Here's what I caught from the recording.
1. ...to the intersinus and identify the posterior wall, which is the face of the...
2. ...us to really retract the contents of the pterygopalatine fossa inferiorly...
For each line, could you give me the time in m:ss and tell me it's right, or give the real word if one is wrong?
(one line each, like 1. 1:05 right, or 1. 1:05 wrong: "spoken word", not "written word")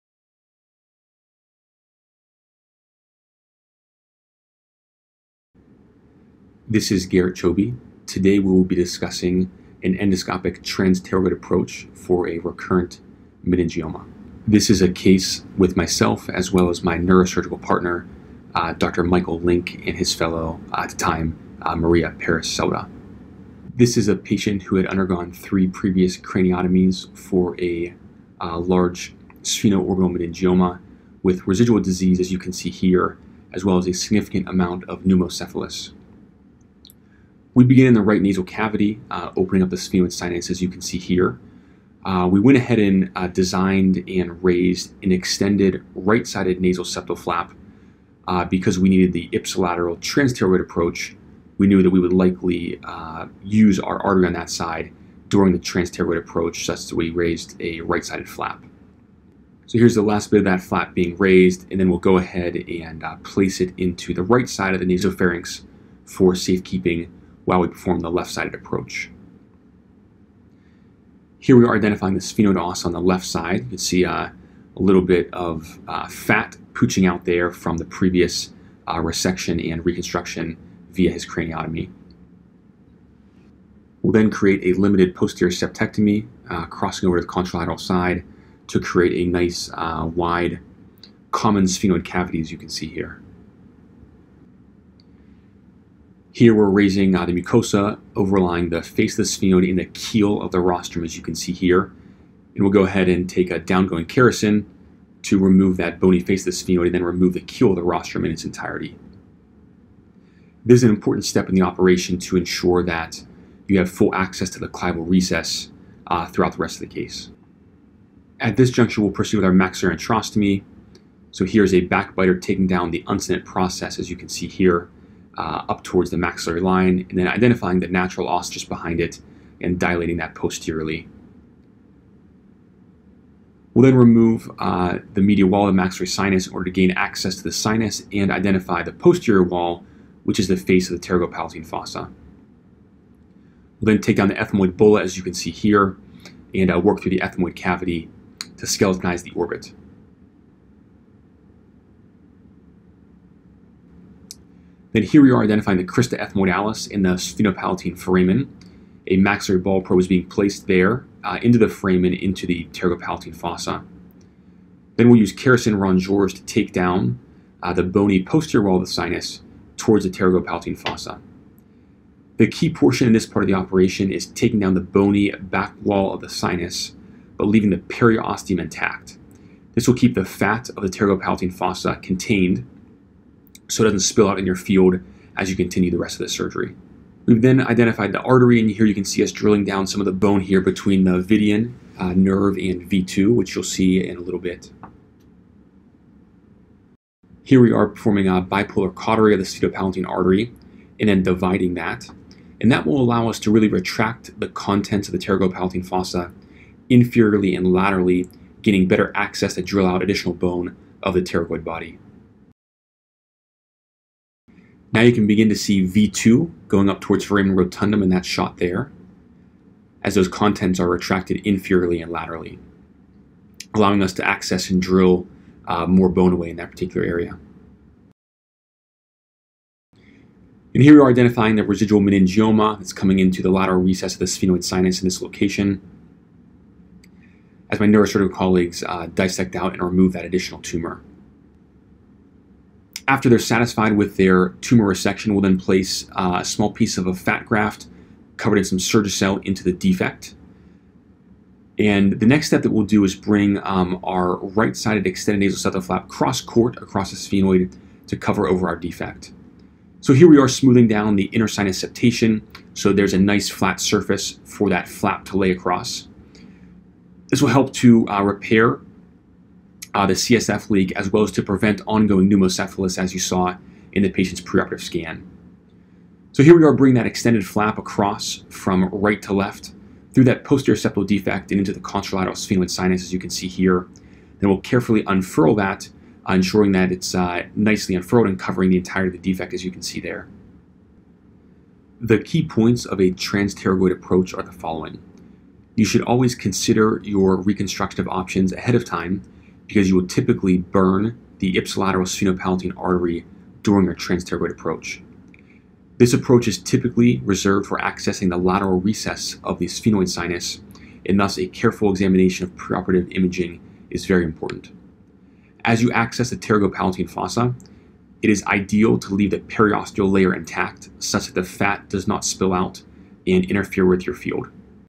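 1. 2:17 wrong: "sinus", not "intersinus"
2. 3:23 right.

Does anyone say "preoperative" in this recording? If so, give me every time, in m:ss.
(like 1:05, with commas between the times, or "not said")
4:34, 5:12.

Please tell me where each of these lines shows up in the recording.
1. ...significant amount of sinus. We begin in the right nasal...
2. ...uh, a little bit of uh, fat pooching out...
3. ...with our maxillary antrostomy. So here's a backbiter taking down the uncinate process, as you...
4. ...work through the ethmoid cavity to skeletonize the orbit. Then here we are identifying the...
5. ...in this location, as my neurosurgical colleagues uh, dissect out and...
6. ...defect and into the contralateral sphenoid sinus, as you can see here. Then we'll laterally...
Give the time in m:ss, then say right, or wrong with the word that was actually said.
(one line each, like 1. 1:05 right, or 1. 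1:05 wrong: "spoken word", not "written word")
1. 0:33 wrong: "pneumocephalus", not "sinus"
2. 1:14 right
3. 1:59 right
4. 2:26 right
5. 3:55 right
6. 4:41 wrong: "carefully", not "laterally".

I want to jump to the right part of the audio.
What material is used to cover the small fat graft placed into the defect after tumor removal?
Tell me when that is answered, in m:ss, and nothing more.
4:08.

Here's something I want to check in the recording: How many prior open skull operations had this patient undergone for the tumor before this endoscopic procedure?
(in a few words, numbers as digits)
3.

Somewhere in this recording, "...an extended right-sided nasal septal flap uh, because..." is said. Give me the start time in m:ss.
0:45.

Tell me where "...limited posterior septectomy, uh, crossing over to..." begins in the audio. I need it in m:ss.
1:24.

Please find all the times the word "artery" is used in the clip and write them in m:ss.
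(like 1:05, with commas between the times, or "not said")
0:54, 3:08, 3:20, 5:02.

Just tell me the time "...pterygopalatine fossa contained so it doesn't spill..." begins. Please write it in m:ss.
3:00.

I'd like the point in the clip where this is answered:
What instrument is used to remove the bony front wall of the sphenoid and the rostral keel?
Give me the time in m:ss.
1:43.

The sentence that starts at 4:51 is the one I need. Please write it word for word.
The key points of a transpterygoid approach are the following.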